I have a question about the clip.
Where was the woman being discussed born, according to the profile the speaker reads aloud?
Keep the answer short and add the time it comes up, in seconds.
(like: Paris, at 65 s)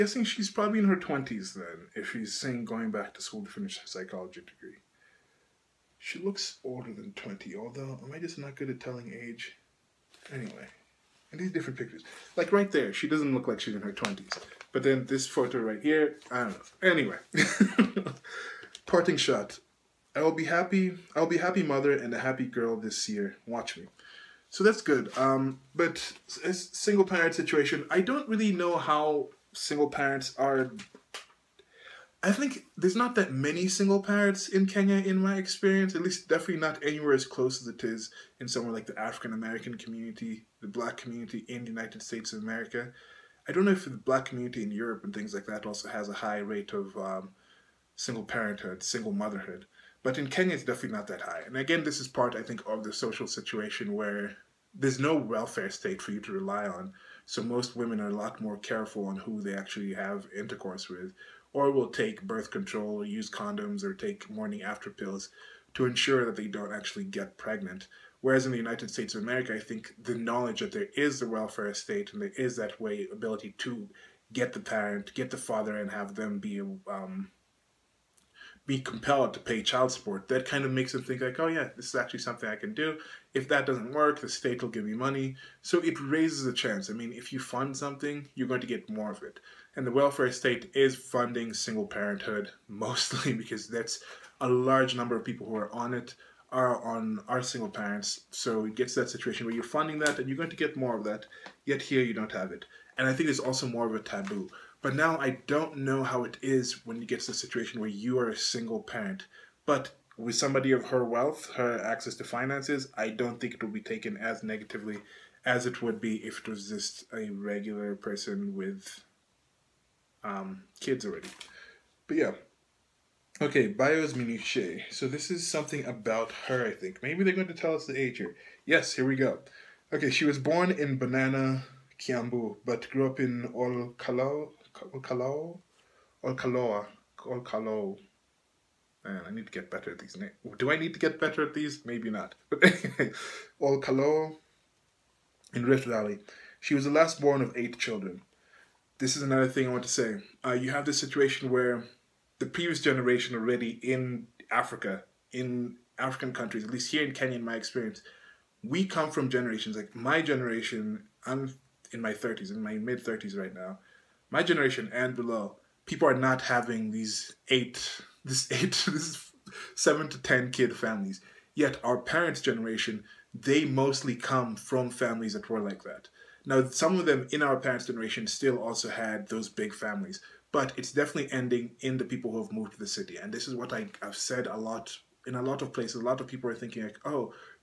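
Banana, Kiambu, at 130 s.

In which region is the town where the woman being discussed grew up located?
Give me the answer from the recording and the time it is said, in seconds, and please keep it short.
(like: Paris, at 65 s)
Rift Valley, at 145 s.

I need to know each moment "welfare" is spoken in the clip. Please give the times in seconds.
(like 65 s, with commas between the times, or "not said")
55 s, 71 s, 89 s.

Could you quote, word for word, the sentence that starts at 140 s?
Do I need to get better at these?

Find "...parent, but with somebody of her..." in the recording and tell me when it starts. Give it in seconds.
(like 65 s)
108 s.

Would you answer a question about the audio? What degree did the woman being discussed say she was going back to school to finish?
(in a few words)
psychology degree.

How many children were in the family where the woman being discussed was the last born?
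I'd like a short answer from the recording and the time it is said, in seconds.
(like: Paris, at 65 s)
8, at 147 s.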